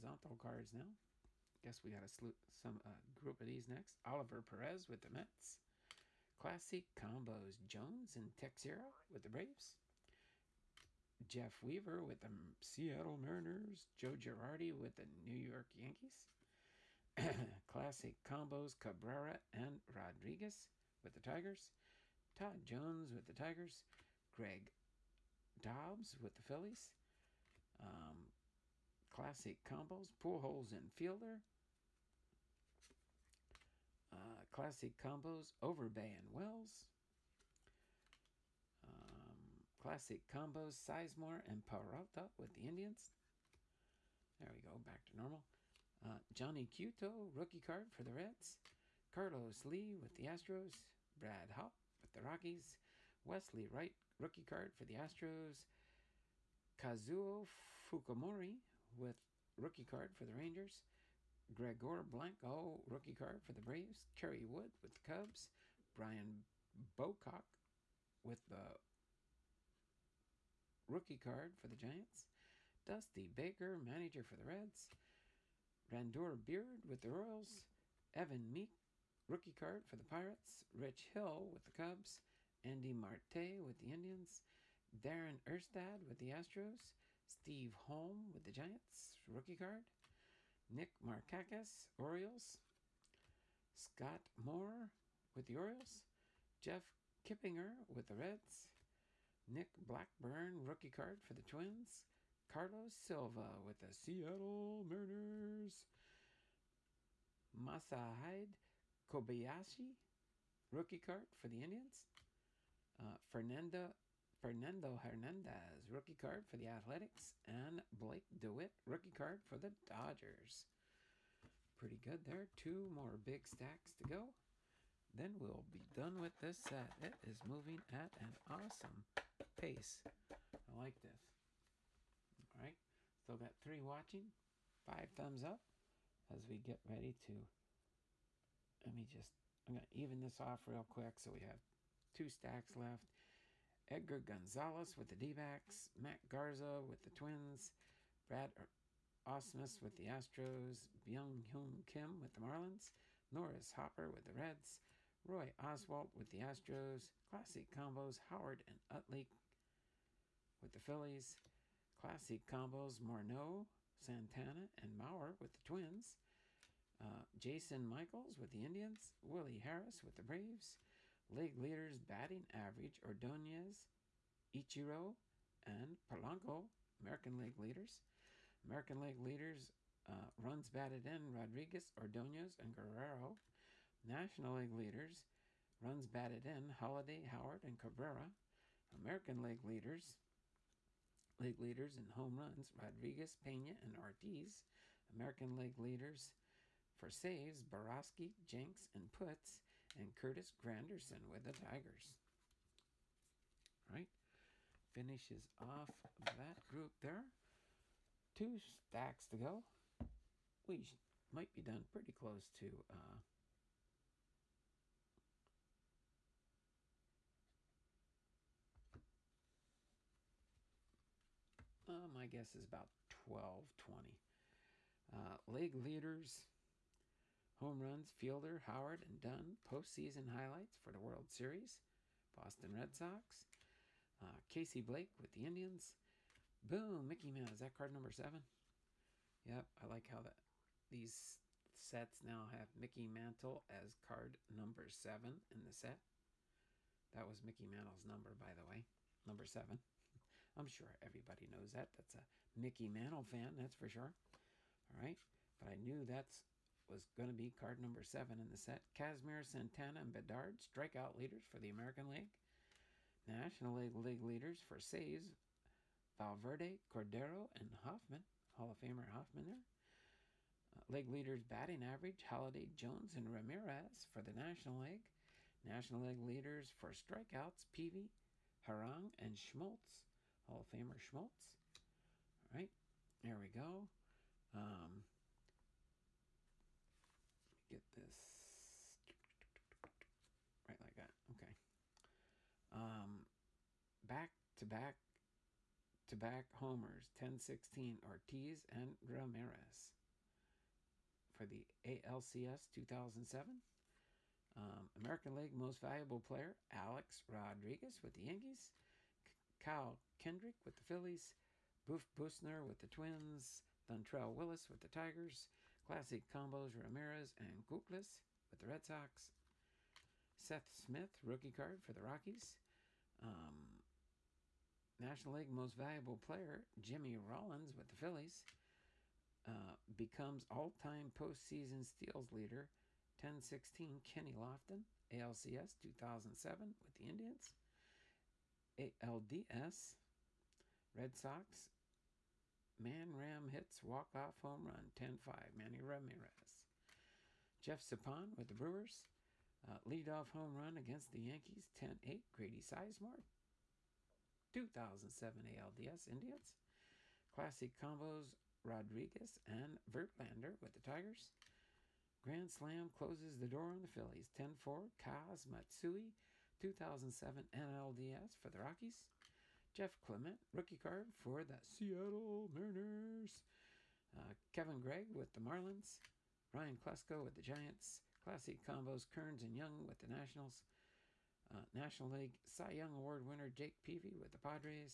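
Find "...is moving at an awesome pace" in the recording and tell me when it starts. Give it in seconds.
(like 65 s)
127 s.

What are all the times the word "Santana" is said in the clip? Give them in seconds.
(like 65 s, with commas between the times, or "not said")
163 s, 259 s.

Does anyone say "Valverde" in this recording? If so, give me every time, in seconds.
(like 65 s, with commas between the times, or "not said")
266 s.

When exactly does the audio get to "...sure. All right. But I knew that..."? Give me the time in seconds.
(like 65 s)
253 s.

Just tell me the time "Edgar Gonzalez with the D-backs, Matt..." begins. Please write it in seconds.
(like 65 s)
143 s.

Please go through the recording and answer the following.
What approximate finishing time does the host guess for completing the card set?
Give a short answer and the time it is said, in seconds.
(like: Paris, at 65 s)
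12:20, at 223 s.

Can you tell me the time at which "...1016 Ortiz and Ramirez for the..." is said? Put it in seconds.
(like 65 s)
297 s.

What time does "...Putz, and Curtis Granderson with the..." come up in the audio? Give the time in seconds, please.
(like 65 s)
199 s.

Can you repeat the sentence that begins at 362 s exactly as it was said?
Grand Slam closes the door on the Phillies.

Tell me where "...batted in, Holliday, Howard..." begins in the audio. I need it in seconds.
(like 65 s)
186 s.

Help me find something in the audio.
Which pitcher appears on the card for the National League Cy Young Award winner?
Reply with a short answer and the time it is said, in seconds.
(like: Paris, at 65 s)
Jake Peavy, at 383 s.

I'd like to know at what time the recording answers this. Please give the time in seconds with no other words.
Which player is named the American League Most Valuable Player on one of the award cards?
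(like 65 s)
306 s.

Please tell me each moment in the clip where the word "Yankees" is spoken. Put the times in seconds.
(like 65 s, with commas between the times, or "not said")
15 s, 308 s, 351 s.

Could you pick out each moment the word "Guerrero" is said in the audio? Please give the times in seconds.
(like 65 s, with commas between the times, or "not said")
182 s.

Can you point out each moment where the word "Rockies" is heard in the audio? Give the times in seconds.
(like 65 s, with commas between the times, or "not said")
52 s, 322 s, 368 s.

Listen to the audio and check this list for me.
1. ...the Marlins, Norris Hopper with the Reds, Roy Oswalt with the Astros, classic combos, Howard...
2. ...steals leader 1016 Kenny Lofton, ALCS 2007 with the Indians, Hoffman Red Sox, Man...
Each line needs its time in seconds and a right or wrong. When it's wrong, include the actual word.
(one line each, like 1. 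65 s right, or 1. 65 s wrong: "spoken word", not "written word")
1. 152 s right
2. 331 s wrong: "ALDS", not "Hoffman".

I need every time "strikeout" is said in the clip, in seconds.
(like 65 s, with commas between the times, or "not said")
260 s, 276 s.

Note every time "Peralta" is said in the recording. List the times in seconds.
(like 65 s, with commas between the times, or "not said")
41 s.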